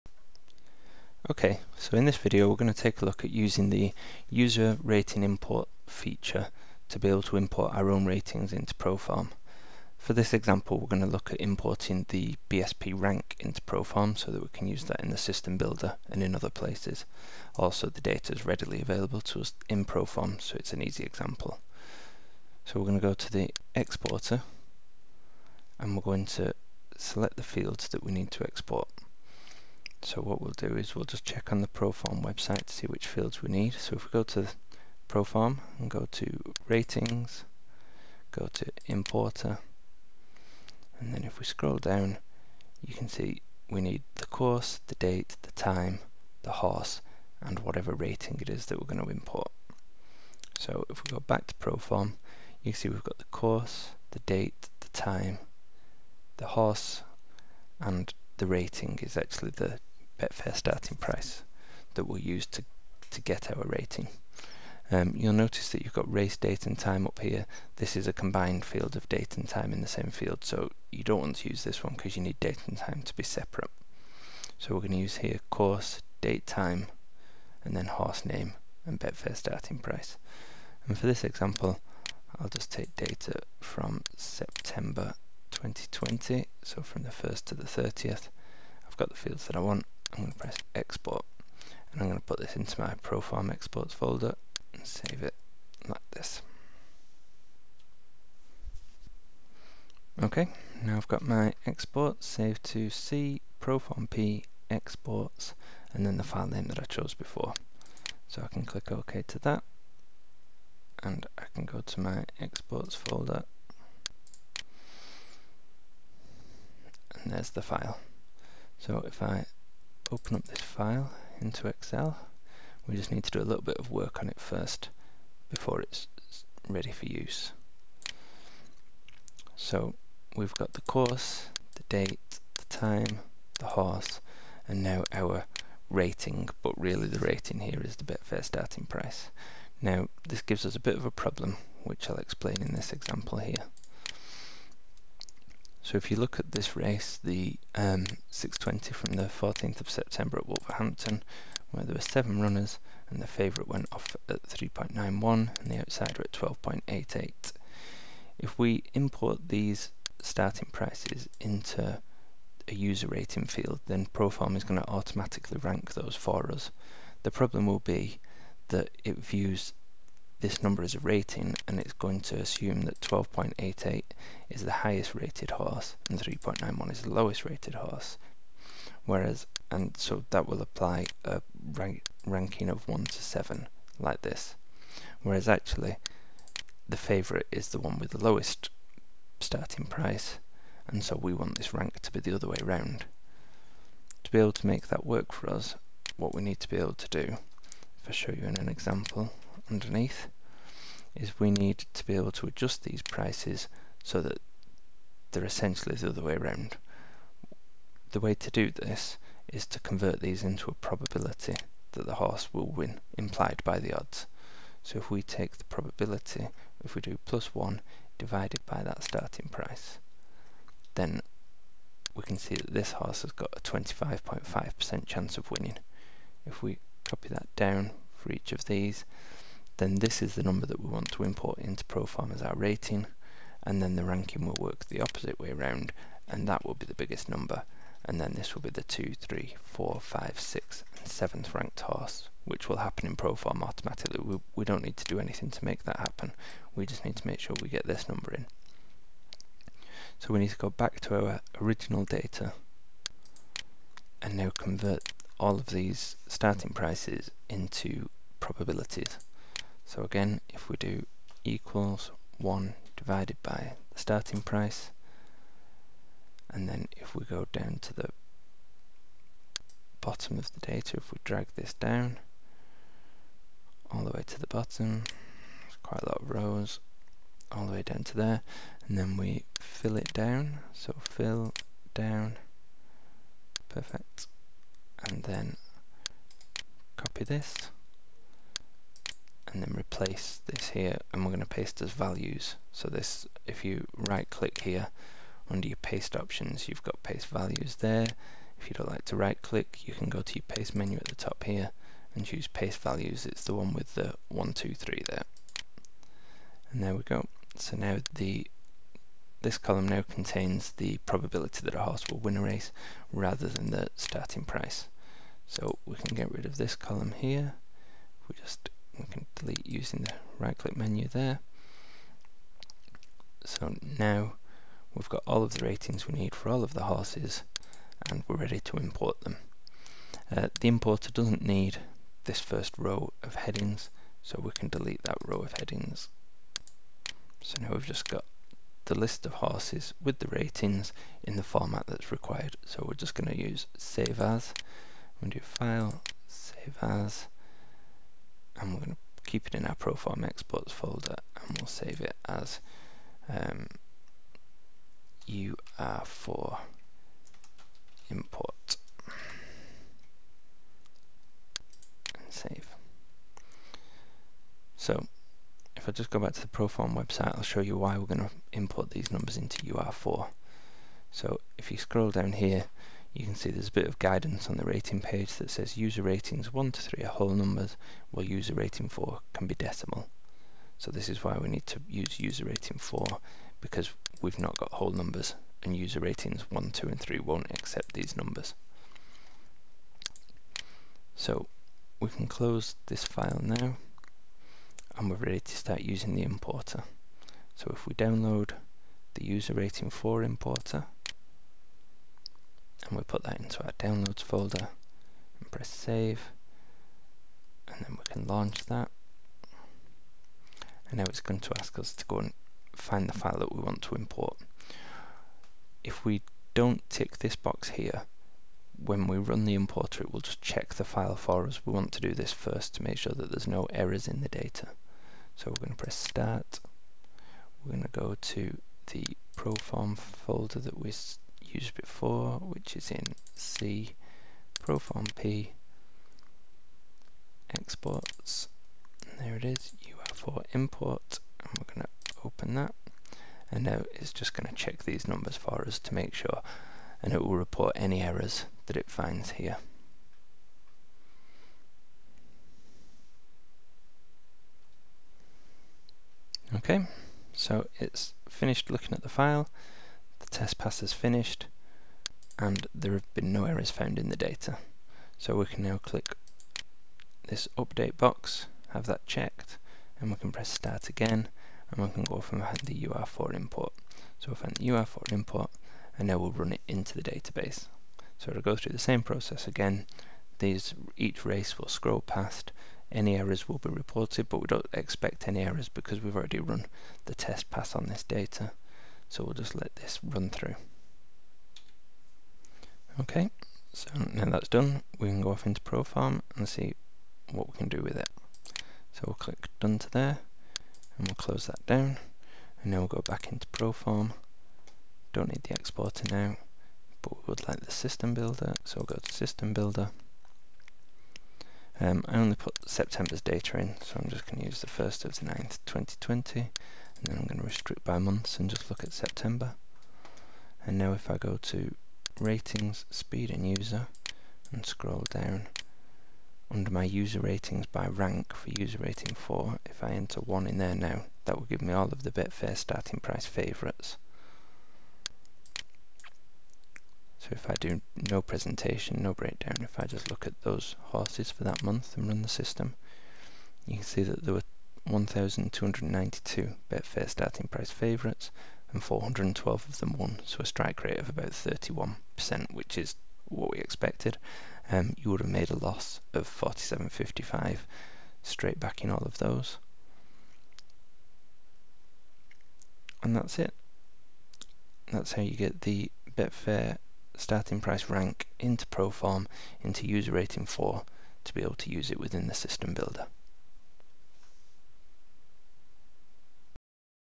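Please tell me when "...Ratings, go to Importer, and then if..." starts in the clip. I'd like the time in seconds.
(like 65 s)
36 s.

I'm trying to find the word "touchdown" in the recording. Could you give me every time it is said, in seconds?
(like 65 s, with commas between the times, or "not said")
not said.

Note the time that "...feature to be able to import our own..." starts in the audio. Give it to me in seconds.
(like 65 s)
5 s.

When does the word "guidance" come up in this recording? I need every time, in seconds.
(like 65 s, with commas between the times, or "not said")
373 s.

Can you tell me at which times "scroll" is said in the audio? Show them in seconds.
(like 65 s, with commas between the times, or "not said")
41 s, 371 s, 481 s, 524 s.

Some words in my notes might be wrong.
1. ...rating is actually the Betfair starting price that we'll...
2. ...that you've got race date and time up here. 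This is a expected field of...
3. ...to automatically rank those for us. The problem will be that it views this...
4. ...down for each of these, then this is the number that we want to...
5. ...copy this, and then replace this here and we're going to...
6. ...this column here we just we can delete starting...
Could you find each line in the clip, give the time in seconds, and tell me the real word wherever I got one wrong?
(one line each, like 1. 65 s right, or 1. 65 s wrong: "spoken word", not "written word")
1. 58 s right
2. 65 s wrong: "combined", not "expected"
3. 164 s right
4. 227 s right
5. 286 s right
6. 316 s wrong: "using", not "starting".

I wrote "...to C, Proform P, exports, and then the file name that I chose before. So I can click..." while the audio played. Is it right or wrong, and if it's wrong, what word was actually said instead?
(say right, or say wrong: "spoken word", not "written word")
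right.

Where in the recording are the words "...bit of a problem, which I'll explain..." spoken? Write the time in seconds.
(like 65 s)
140 s.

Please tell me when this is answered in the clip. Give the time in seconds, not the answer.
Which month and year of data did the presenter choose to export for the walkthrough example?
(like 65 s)
84 s.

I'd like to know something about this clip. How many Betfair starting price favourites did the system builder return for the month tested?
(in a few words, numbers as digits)
1,292.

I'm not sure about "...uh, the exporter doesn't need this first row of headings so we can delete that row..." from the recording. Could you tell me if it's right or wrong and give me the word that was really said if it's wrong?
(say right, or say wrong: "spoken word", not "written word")
wrong: "importer", not "exporter".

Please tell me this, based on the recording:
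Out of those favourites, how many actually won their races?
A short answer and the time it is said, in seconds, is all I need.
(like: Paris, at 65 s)
412, at 548 s.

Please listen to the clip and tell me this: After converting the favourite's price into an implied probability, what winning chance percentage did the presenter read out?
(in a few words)
25.5%.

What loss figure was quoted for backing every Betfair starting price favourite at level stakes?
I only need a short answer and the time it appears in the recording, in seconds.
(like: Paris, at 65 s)
47.55, at 556 s.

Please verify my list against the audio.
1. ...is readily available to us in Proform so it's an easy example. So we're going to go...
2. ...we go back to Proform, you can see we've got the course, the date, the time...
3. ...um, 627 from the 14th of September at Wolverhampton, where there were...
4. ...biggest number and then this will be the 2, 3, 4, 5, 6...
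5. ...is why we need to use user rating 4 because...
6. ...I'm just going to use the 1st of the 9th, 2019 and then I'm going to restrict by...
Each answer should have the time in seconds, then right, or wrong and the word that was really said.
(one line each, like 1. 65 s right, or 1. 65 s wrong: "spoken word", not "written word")
1. 18 s right
2. 51 s right
3. 147 s wrong: "620", not "627"
4. 236 s right
5. 381 s right
6. 514 s wrong: "2020", not "2019".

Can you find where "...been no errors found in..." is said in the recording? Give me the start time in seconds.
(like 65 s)
463 s.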